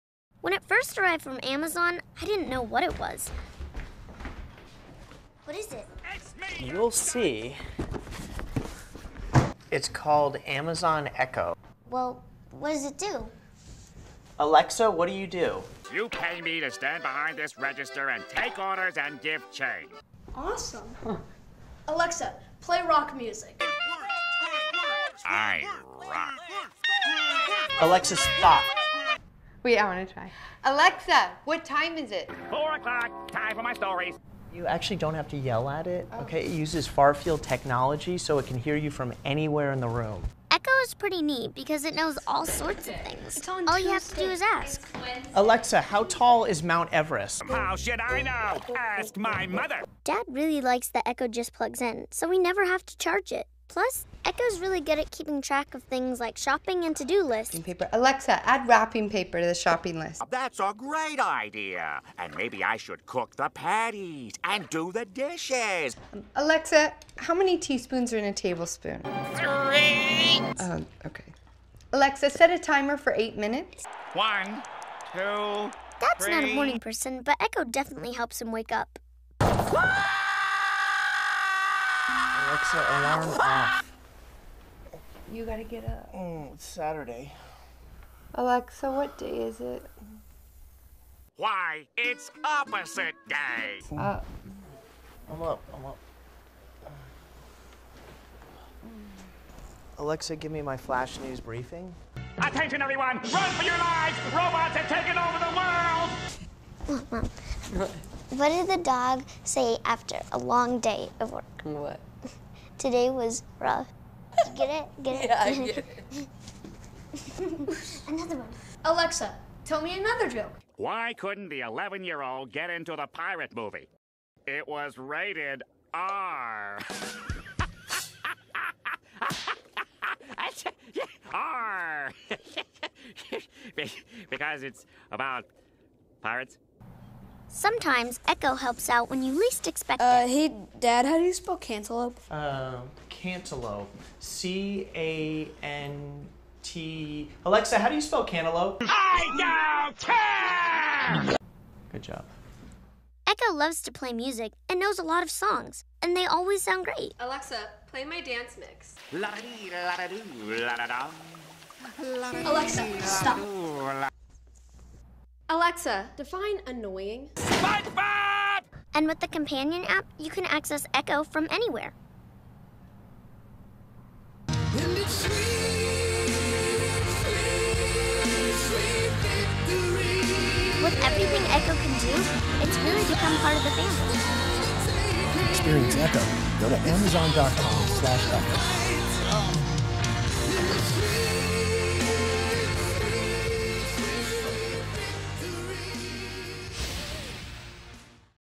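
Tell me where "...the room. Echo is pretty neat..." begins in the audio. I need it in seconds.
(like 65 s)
39 s.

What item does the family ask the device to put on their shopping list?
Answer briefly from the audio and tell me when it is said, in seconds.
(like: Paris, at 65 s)
wrapping paper, at 58 s.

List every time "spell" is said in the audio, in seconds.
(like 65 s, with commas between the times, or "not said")
141 s, 148 s.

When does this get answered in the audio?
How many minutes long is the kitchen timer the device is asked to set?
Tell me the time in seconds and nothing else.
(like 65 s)
73 s.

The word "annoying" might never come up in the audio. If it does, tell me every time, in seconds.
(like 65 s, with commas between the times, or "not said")
166 s.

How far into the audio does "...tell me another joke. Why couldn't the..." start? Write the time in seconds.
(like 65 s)
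119 s.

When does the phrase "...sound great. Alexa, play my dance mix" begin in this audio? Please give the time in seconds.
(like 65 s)
156 s.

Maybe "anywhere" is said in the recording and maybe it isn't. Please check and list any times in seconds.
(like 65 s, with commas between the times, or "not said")
39 s, 171 s.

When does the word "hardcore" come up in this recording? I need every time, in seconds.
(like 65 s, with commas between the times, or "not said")
not said.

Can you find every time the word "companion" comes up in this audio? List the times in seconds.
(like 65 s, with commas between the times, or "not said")
169 s.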